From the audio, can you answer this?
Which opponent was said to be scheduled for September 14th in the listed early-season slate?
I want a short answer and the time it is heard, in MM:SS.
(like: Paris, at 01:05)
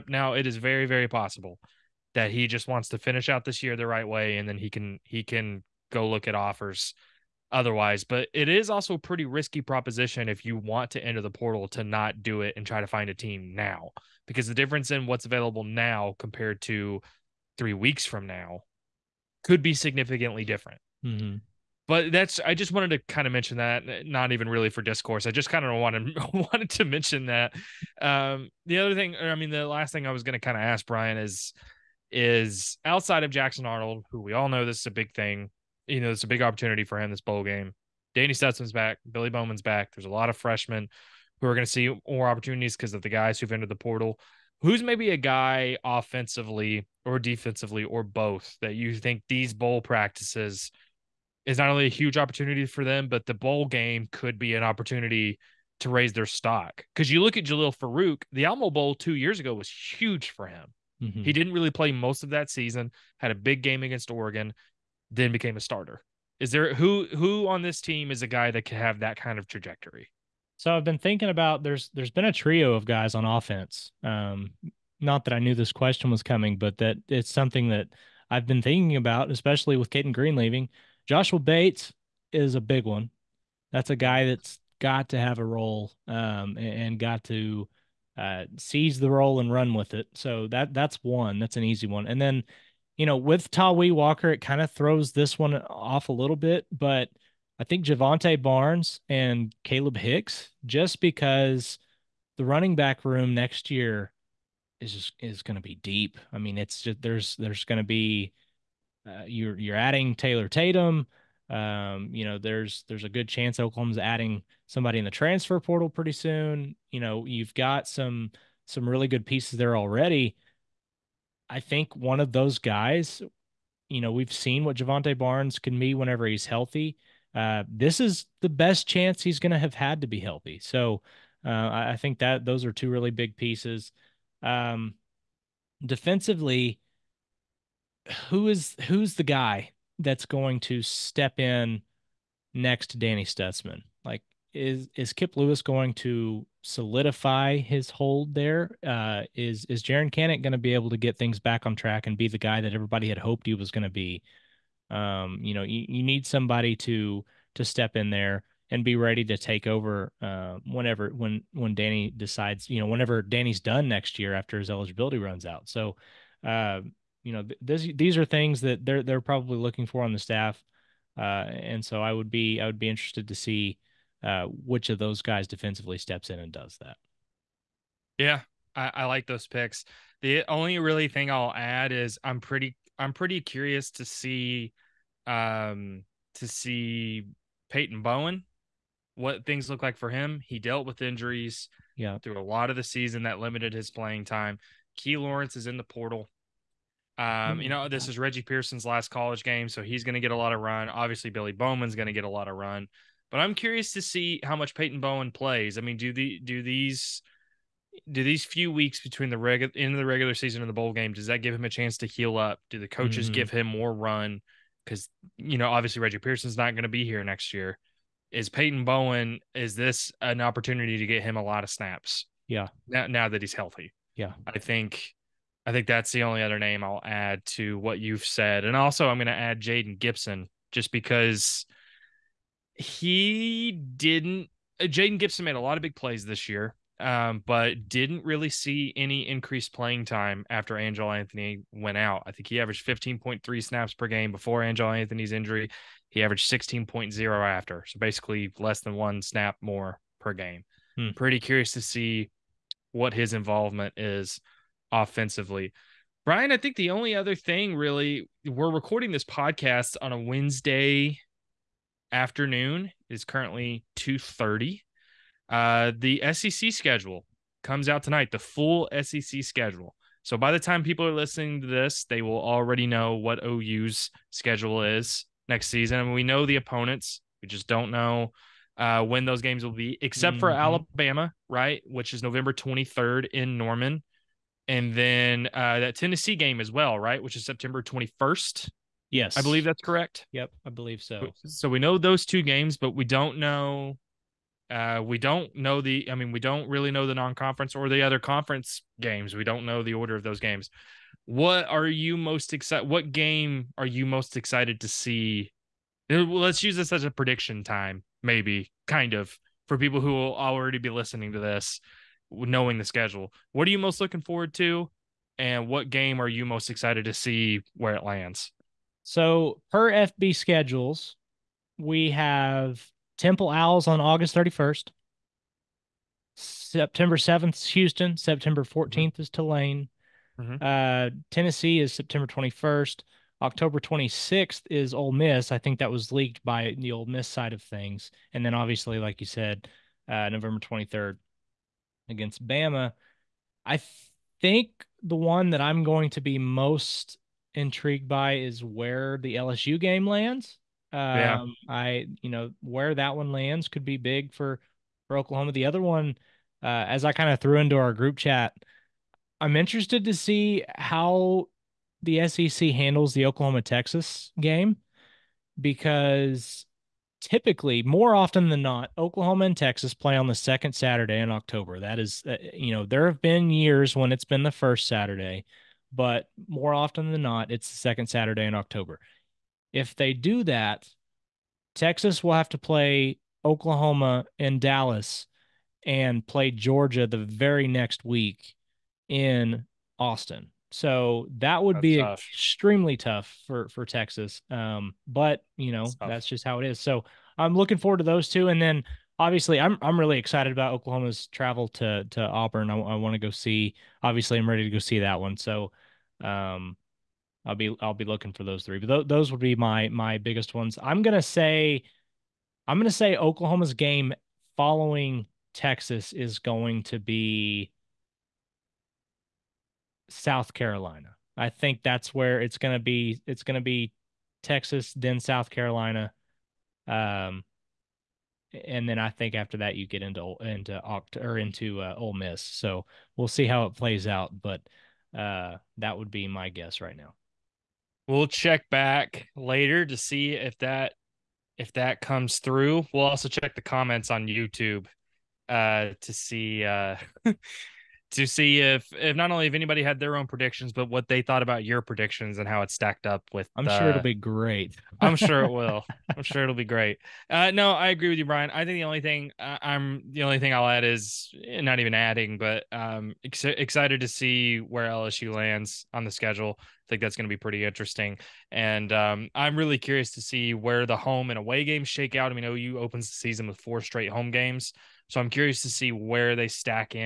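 Tulane, at 05:29.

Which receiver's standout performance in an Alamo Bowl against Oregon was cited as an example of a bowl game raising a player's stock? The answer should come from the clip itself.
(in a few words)
Jalil Farooq.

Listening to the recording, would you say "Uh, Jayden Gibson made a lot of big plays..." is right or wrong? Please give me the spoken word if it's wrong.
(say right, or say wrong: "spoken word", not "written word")
right.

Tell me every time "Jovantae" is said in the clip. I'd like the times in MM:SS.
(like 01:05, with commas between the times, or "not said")
01:37, 02:04.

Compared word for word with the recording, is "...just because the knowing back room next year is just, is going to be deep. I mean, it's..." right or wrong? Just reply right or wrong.
wrong.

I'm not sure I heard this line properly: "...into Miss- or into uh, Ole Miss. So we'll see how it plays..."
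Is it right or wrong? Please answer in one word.
wrong.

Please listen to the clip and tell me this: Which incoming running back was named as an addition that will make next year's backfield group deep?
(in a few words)
Taylor Tatum.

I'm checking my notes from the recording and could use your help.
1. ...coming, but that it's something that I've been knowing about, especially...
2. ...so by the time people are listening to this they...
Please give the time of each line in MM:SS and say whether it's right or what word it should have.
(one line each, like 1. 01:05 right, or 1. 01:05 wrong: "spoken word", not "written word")
1. 01:16 wrong: "thinking", not "knowing"
2. 04:30 right.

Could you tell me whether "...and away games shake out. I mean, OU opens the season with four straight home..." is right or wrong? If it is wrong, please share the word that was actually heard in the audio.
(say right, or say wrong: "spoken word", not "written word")
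right.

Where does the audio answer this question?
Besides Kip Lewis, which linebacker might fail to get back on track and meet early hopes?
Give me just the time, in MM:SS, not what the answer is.
02:29.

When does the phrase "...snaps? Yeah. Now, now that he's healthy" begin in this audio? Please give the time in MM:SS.
03:41.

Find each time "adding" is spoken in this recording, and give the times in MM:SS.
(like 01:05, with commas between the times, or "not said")
01:49, 01:53, 07:41.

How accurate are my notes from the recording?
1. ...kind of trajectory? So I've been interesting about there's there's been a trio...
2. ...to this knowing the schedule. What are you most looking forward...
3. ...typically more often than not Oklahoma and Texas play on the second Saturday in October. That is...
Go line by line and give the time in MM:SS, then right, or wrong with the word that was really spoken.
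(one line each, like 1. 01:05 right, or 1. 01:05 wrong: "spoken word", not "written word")
1. 01:09 wrong: "thinking", not "interesting"
2. 05:11 right
3. 06:07 right.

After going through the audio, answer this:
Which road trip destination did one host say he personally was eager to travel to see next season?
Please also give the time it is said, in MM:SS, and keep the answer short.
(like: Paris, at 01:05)
Auburn, at 06:42.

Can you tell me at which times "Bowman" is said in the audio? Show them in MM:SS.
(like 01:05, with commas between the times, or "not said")
00:39, 03:21.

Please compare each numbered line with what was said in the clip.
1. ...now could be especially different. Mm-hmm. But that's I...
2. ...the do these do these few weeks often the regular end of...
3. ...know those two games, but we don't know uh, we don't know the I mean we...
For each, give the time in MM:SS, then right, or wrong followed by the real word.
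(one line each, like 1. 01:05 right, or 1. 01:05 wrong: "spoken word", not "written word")
1. 00:18 wrong: "significantly", not "especially"
2. 03:26 wrong: "between", not "often"
3. 04:51 right.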